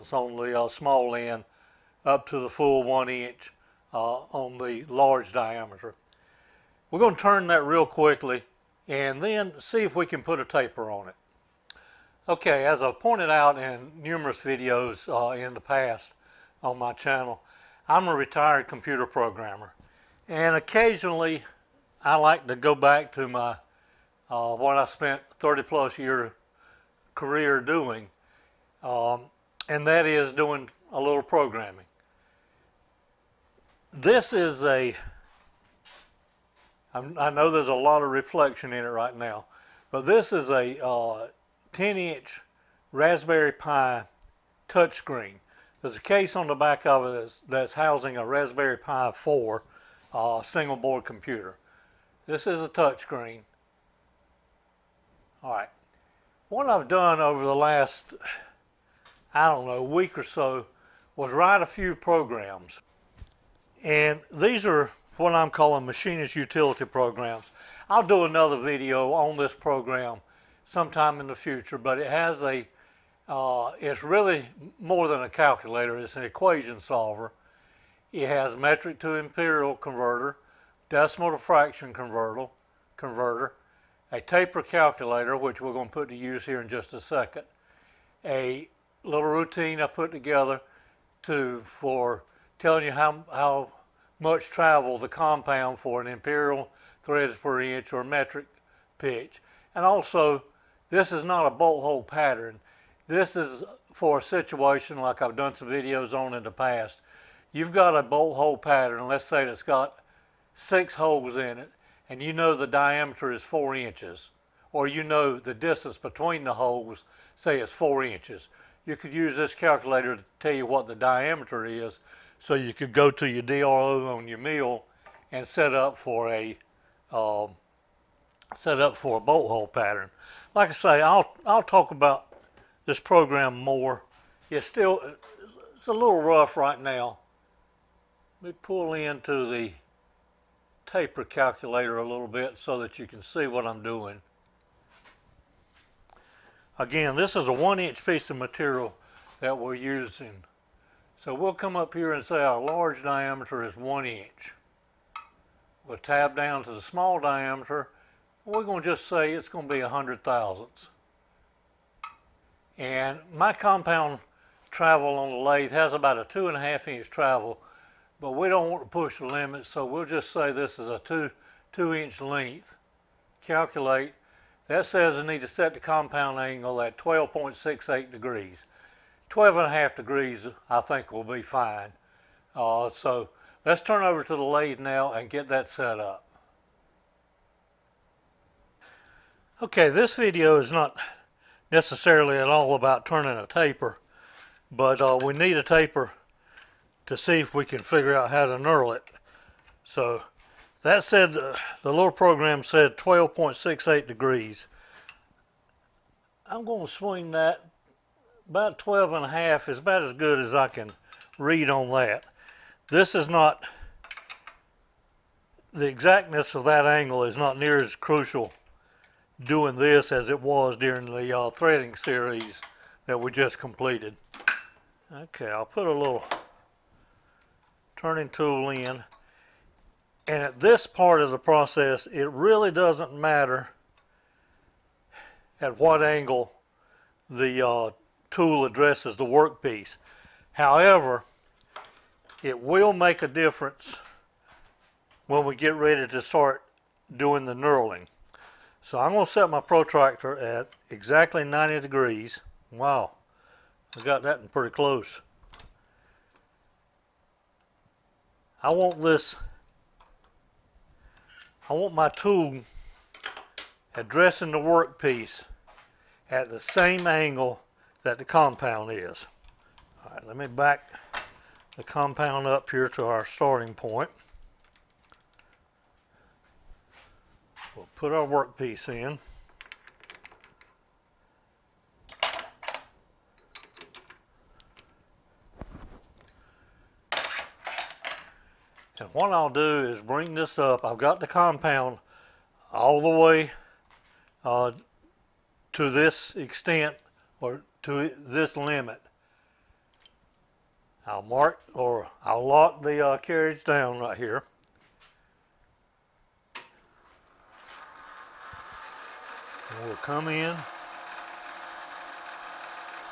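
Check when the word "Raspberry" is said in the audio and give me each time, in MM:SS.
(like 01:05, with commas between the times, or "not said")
00:42, 00:48.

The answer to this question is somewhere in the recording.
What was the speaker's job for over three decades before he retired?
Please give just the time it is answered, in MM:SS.
00:18.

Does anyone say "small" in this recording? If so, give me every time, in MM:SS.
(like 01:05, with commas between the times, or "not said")
00:00, 02:36.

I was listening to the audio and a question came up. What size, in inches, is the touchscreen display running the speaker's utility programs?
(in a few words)
10 inch.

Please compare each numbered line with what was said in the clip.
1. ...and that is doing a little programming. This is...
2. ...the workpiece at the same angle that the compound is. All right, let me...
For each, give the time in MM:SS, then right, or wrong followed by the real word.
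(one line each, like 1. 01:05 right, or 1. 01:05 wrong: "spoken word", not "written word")
1. 00:29 right
2. 04:24 right.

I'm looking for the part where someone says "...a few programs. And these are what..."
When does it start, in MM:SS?
01:01.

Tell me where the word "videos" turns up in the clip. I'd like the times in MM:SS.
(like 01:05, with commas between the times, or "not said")
00:14, 01:08, 01:45, 03:10.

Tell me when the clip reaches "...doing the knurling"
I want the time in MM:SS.
04:07.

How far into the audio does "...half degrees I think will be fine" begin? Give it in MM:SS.
02:59.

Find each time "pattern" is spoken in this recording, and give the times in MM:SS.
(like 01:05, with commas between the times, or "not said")
01:42, 01:48, 02:09.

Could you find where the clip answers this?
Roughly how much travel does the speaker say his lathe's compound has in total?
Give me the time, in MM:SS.
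02:46.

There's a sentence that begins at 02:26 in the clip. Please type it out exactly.
Again, this is a one inch piece of material that we're using.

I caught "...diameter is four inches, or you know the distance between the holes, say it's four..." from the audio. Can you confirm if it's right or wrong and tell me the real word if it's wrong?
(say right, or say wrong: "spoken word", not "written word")
right.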